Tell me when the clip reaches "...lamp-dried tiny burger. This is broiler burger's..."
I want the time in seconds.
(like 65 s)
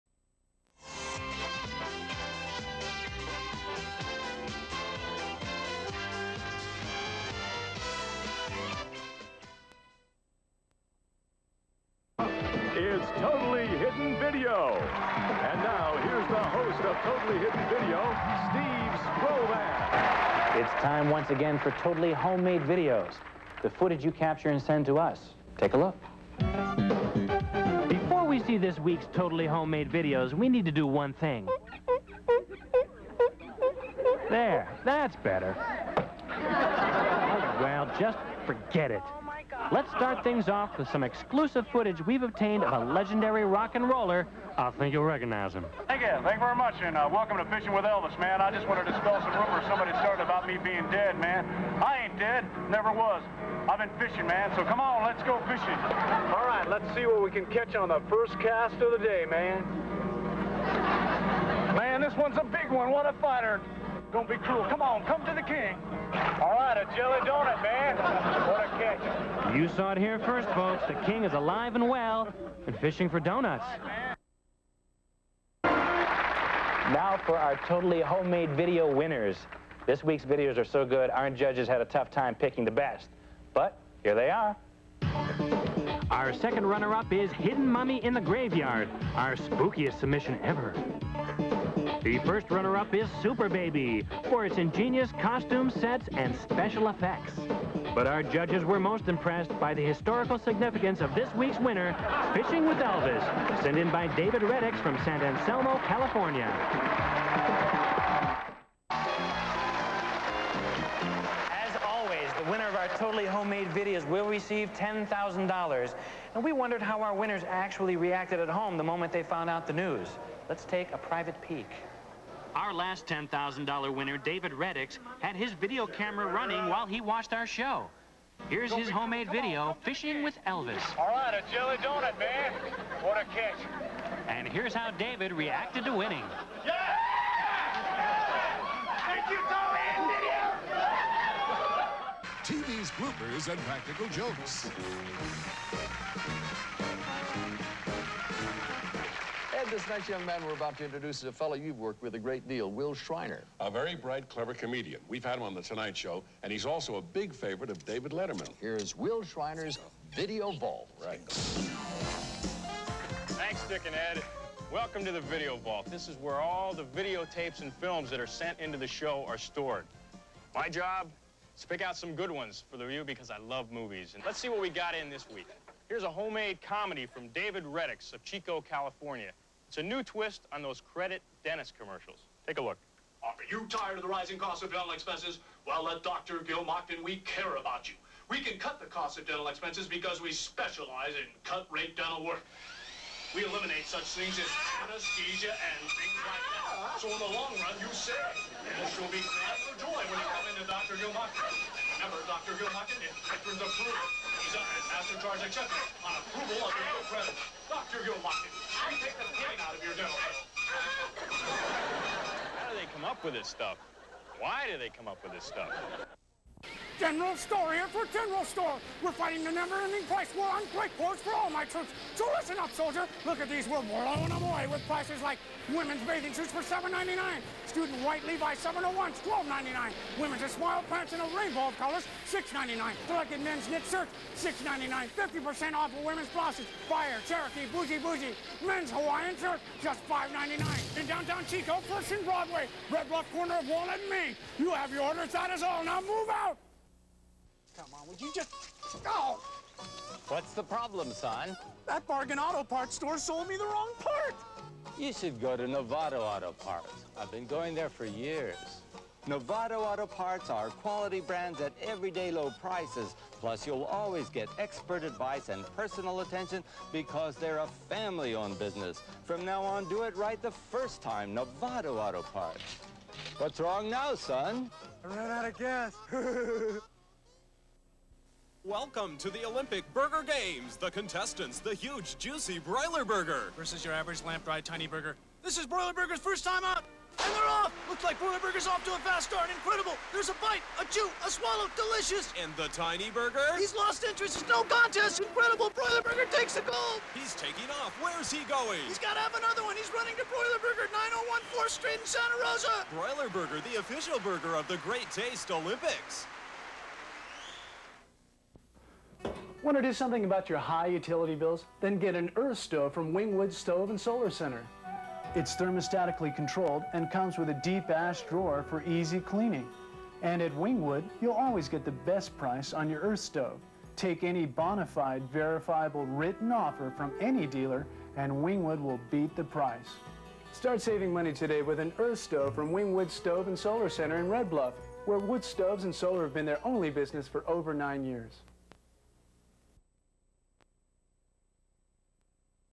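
284 s.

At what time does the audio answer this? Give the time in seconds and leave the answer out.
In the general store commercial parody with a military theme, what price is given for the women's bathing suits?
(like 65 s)
226 s.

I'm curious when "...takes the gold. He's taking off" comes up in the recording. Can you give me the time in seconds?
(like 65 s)
296 s.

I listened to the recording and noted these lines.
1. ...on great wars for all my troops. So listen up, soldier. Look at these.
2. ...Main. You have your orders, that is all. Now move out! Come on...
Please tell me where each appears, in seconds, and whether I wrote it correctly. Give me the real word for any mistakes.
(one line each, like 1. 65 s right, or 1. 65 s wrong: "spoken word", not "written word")
1. 220 s right
2. 244 s right.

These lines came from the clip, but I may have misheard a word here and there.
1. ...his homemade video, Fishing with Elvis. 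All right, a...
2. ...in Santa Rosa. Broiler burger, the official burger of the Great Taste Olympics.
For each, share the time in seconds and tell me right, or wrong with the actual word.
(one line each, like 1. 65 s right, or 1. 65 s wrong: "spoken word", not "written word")
1. 128 s right
2. 301 s right.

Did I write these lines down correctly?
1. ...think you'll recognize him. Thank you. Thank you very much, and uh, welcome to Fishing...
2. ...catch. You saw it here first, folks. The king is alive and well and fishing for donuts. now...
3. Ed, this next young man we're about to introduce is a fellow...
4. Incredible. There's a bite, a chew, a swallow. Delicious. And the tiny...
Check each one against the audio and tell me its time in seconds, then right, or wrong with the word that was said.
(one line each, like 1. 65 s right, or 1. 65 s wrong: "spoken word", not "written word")
1. 44 s right
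2. 68 s right
3. 149 s right
4. 289 s right.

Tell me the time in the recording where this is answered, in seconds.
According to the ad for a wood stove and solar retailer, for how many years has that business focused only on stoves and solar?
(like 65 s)
337 s.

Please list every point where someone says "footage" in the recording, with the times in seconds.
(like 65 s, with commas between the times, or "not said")
23 s, 41 s.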